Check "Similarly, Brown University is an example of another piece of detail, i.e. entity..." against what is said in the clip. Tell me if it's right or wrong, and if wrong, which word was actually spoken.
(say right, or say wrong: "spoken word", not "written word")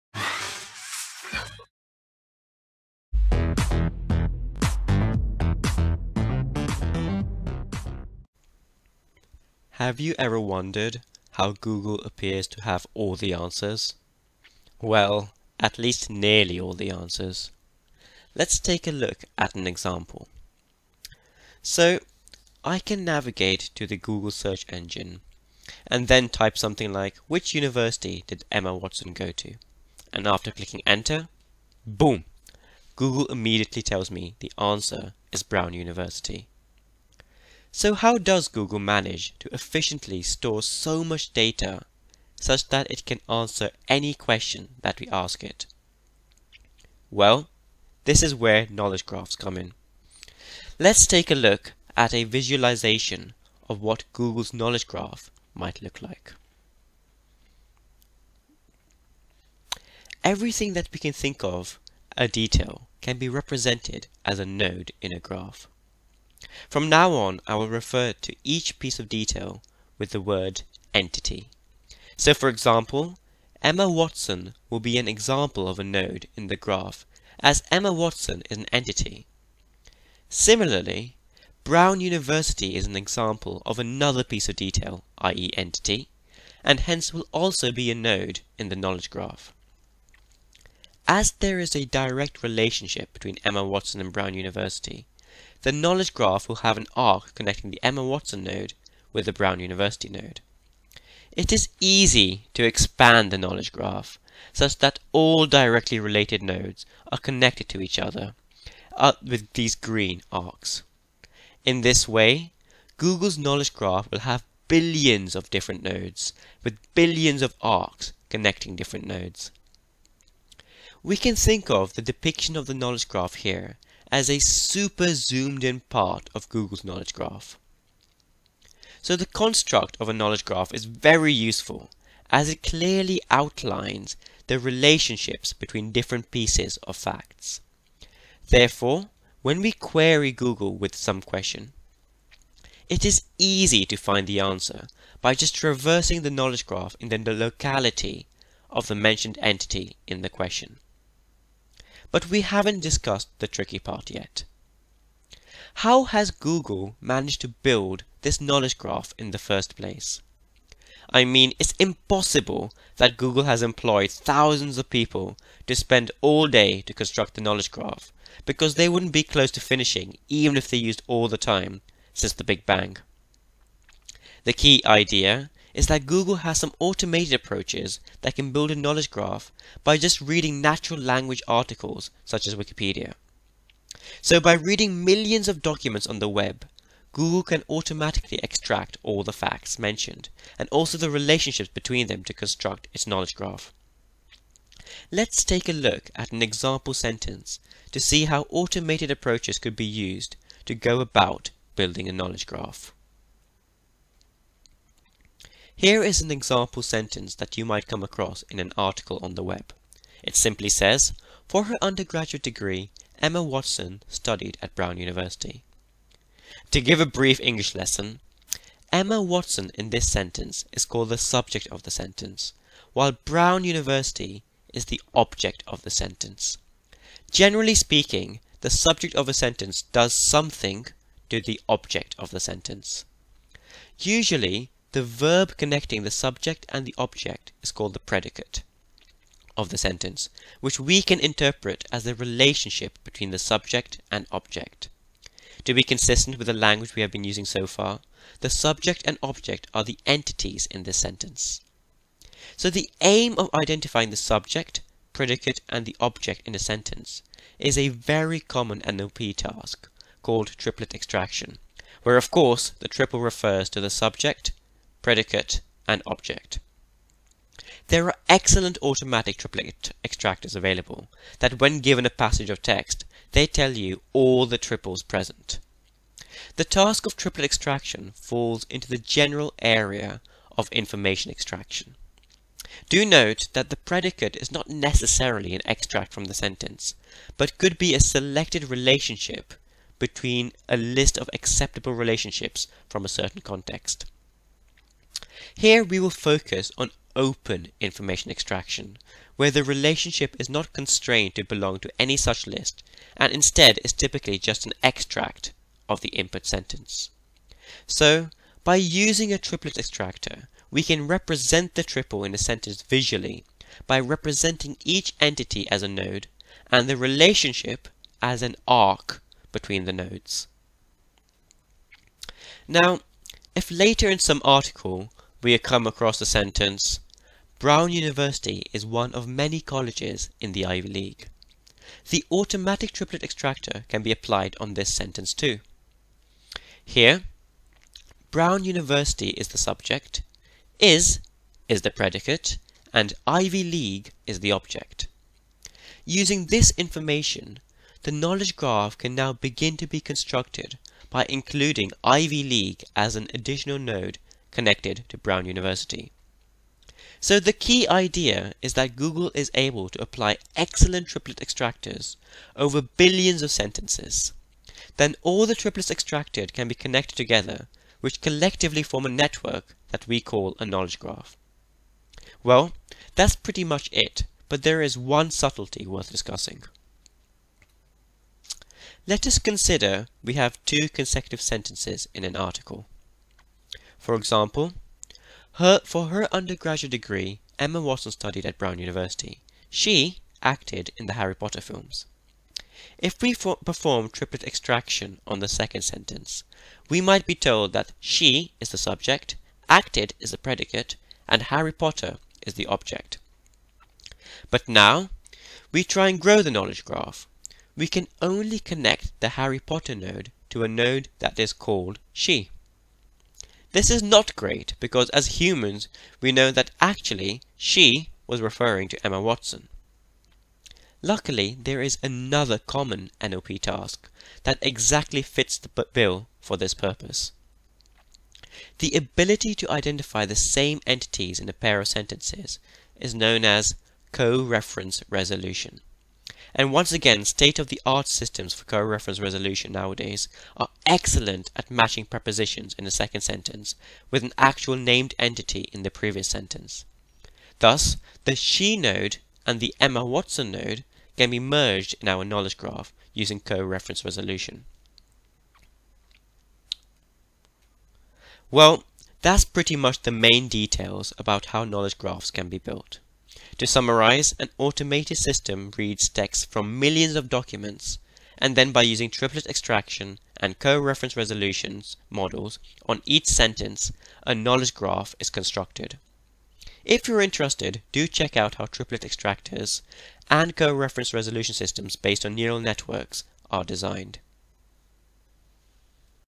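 right.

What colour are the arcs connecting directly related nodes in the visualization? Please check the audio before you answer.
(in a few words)
green.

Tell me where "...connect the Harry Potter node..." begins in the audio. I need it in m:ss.
6:48.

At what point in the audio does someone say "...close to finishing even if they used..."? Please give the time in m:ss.
2:49.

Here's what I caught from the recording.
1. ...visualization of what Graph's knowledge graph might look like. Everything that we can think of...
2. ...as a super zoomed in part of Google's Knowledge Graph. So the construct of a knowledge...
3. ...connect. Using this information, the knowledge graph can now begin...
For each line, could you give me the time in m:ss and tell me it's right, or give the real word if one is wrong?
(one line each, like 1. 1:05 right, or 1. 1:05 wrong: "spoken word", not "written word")
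1. 0:52 wrong: "Google", not "Graph"
2. 2:04 right
3. 5:44 wrong: "object", not "connect".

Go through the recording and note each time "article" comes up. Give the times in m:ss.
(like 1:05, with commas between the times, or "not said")
3:01, 3:28, 5:24, 6:22.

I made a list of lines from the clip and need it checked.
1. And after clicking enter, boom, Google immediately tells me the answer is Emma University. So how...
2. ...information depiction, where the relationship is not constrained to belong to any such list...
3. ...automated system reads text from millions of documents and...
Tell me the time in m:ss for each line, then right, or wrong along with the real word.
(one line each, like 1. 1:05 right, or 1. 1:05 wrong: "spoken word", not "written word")
1. 0:30 wrong: "Brown", not "Emma"
2. 4:57 wrong: "extraction", not "depiction"
3. 7:44 right.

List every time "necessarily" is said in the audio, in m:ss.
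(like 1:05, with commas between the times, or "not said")
4:44.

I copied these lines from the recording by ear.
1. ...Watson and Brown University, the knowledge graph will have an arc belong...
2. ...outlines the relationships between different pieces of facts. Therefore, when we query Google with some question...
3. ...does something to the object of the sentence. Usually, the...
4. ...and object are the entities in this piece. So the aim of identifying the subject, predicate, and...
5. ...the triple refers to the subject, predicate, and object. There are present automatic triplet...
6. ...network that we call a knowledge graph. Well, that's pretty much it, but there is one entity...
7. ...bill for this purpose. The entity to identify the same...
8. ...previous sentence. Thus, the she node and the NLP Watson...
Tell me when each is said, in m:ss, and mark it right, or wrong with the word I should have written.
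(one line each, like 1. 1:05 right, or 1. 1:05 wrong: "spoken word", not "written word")
1. 1:33 wrong: "connecting", not "belong"
2. 2:13 right
3. 3:49 right
4. 4:09 wrong: "sentence", not "piece"
5. 4:22 wrong: "excellent", not "present"
6. 6:09 wrong: "subtlety", not "entity"
7. 7:05 wrong: "ability", not "entity"
8. 7:25 wrong: "Emma", not "NLP".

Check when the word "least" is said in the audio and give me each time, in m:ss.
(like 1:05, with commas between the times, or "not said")
0:15.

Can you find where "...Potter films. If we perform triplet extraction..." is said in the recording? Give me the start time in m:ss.
6:31.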